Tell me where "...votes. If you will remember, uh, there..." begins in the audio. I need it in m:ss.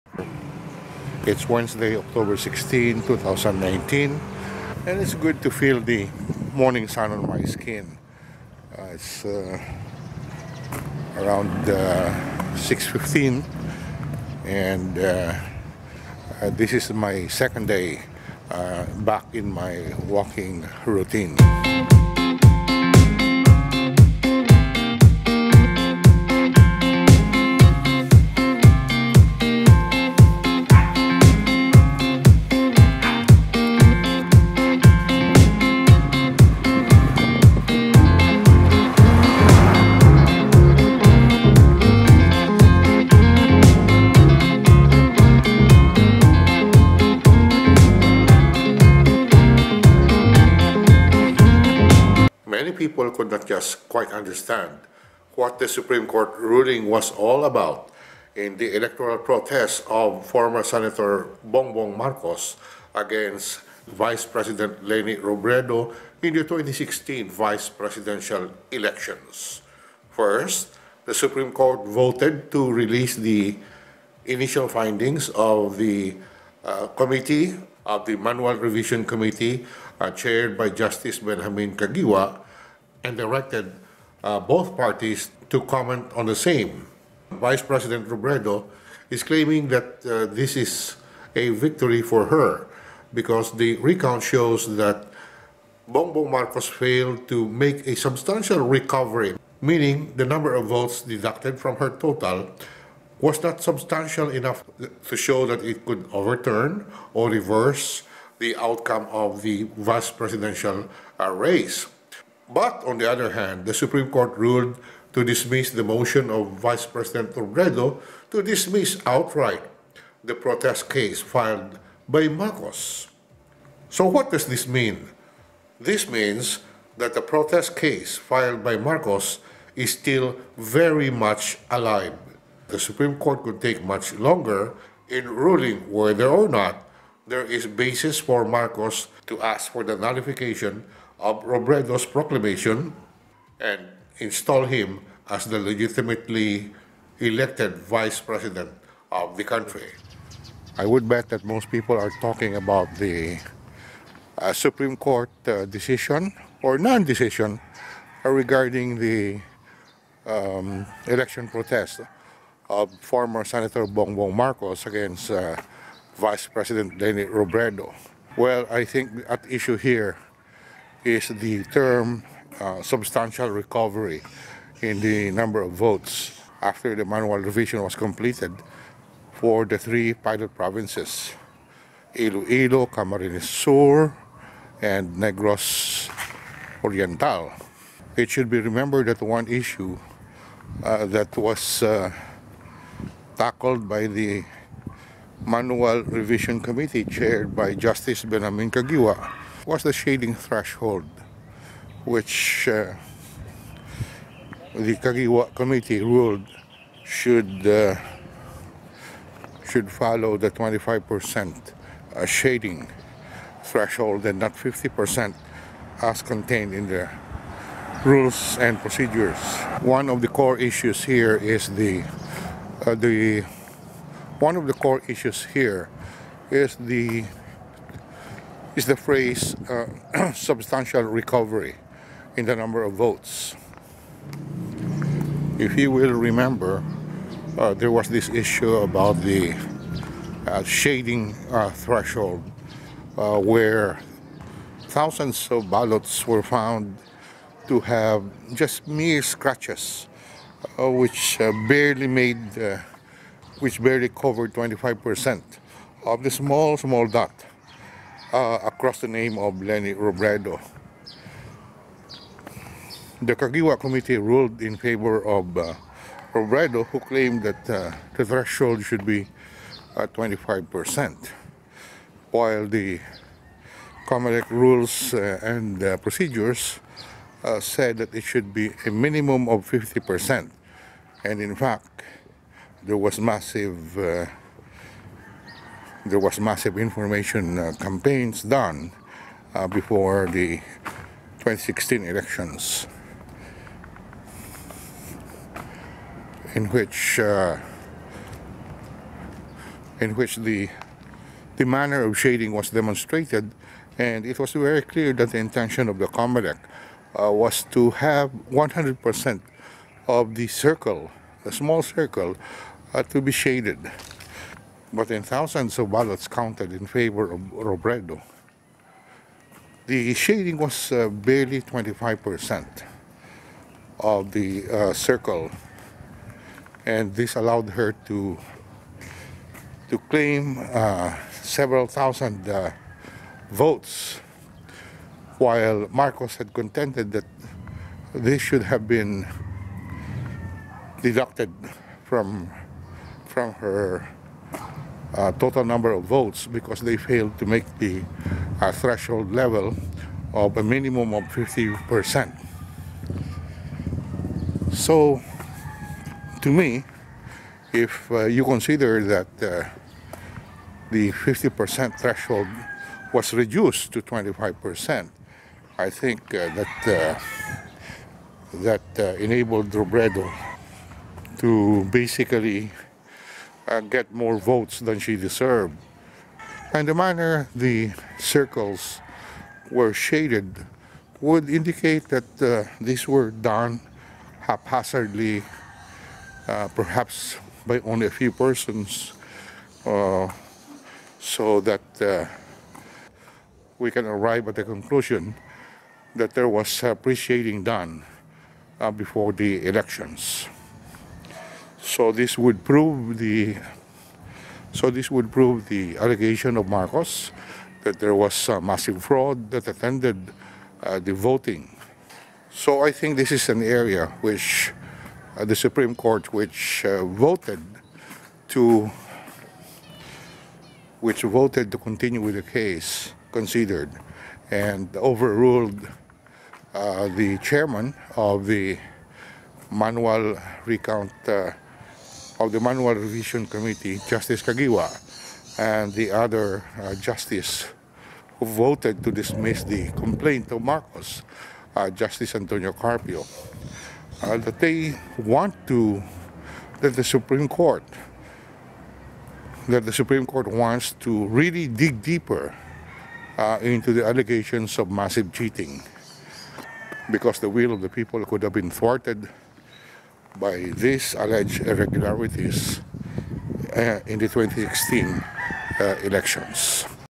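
3:52.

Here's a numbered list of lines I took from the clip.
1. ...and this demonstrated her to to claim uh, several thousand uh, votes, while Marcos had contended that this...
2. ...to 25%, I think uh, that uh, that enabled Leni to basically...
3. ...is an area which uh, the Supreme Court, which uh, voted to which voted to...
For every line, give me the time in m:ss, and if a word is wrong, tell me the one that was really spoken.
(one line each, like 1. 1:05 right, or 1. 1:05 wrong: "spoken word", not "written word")
1. 5:26 wrong: "allowed", not "demonstrated"
2. 6:03 wrong: "Robredo", not "Leni"
3. 6:53 right.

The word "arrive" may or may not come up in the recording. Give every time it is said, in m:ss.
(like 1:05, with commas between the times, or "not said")
6:34.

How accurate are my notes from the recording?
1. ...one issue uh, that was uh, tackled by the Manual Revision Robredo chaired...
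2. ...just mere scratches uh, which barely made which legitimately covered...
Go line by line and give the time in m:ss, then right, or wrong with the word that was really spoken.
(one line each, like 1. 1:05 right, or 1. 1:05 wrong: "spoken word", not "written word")
1. 3:09 wrong: "Committee", not "Robredo"
2. 4:08 wrong: "barely", not "legitimately".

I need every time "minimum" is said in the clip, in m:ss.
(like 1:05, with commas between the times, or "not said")
4:38, 5:50.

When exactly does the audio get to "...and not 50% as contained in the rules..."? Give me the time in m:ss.
3:34.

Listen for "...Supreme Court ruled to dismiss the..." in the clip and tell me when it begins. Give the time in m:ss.
1:53.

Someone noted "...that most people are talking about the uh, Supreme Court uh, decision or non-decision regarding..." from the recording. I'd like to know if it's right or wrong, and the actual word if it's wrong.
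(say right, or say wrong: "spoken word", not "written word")
right.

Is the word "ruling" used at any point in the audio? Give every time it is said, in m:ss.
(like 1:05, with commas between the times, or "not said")
0:56, 2:15.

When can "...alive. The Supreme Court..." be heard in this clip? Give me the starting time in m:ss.
2:11.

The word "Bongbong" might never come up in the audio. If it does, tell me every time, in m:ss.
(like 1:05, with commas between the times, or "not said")
1:01, 1:35, 2:43.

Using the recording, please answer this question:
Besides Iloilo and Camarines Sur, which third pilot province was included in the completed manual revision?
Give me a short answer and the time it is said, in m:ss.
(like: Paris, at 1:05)
Negros Oriental, at 3:05.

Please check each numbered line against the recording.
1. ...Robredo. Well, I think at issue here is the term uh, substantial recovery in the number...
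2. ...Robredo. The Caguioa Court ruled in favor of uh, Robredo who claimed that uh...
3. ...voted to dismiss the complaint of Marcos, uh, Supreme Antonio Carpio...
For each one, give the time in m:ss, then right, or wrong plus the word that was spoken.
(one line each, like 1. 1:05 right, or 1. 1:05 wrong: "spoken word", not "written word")
1. 2:47 right
2. 4:19 wrong: "Committee", not "Court"
3. 7:18 wrong: "Justice", not "Supreme".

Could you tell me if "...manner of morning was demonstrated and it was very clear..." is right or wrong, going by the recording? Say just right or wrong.
wrong.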